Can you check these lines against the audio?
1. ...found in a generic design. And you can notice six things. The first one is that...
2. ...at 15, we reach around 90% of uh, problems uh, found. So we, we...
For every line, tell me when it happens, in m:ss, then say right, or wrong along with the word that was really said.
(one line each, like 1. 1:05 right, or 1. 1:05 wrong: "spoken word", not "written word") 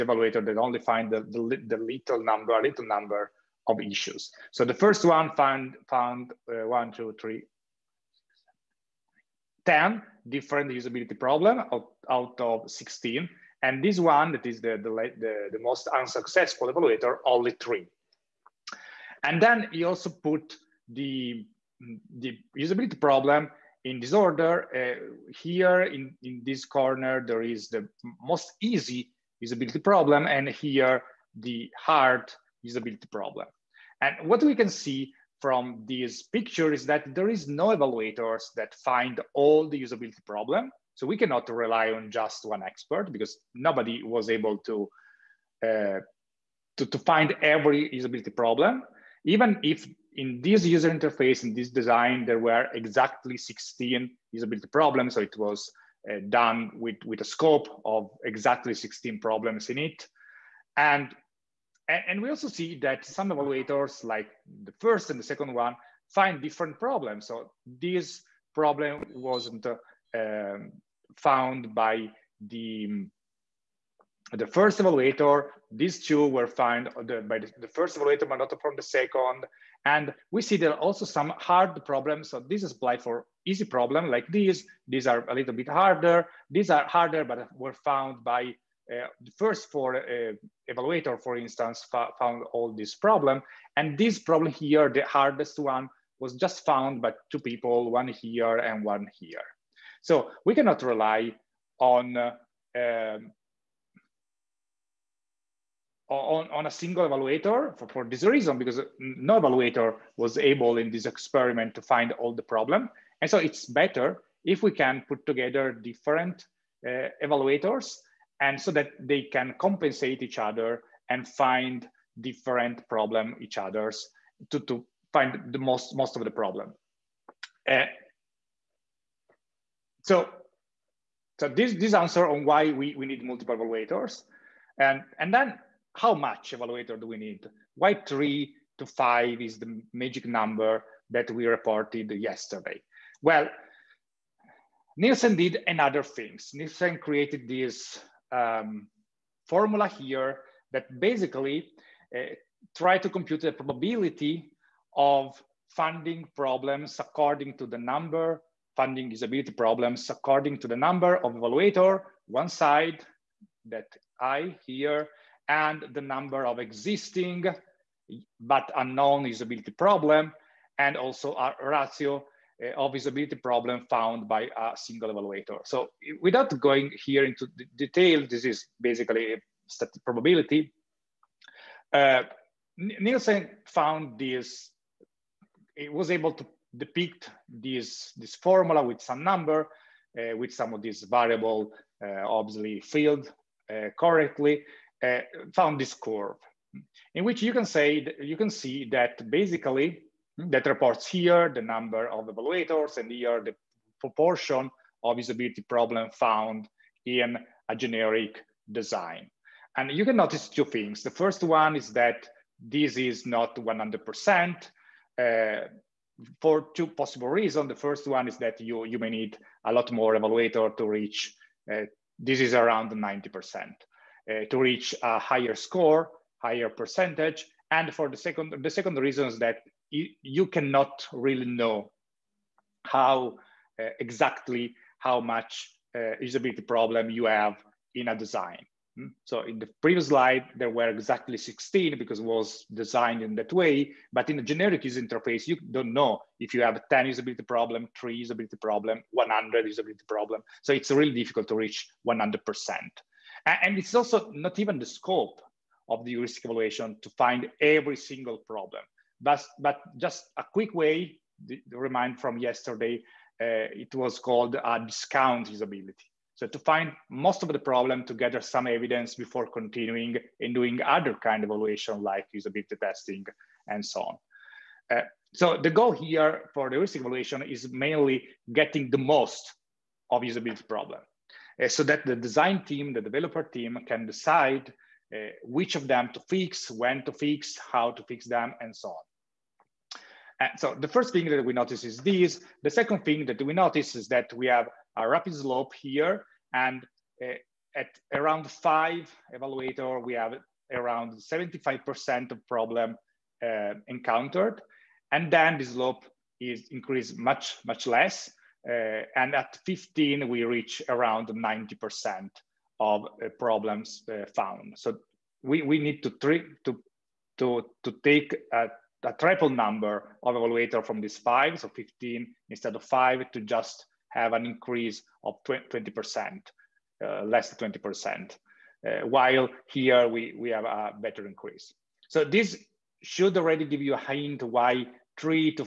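1. 3:26 wrong: "two", not "six"
2. 5:09 right.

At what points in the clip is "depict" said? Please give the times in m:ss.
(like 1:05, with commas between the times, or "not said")
3:06.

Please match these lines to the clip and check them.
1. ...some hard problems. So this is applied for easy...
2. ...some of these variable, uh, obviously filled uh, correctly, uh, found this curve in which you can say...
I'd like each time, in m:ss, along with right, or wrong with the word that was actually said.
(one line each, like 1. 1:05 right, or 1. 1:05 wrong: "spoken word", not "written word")
1. 1:21 right
2. 3:10 right.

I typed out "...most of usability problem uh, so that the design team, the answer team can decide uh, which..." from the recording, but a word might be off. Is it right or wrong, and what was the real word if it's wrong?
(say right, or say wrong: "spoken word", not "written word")
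wrong: "developer", not "answer".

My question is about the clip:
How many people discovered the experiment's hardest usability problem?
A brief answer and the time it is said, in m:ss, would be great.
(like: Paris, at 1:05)
2, at 1:36.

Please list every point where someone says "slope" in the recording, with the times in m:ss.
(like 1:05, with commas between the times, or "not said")
4:55, 5:05.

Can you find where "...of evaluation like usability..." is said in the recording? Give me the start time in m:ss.
4:31.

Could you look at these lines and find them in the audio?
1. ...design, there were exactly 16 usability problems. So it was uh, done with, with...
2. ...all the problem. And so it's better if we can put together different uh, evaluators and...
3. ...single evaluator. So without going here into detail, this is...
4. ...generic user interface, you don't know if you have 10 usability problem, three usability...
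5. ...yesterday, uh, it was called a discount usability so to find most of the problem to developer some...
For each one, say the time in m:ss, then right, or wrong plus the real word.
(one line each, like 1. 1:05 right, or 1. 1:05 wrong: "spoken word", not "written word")
1. 0:51 right
2. 1:52 right
3. 2:54 right
4. 4:04 right
5. 4:22 wrong: "gather", not "developer".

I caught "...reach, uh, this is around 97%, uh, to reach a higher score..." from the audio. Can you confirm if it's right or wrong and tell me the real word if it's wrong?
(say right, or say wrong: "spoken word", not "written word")
wrong: "90", not "97".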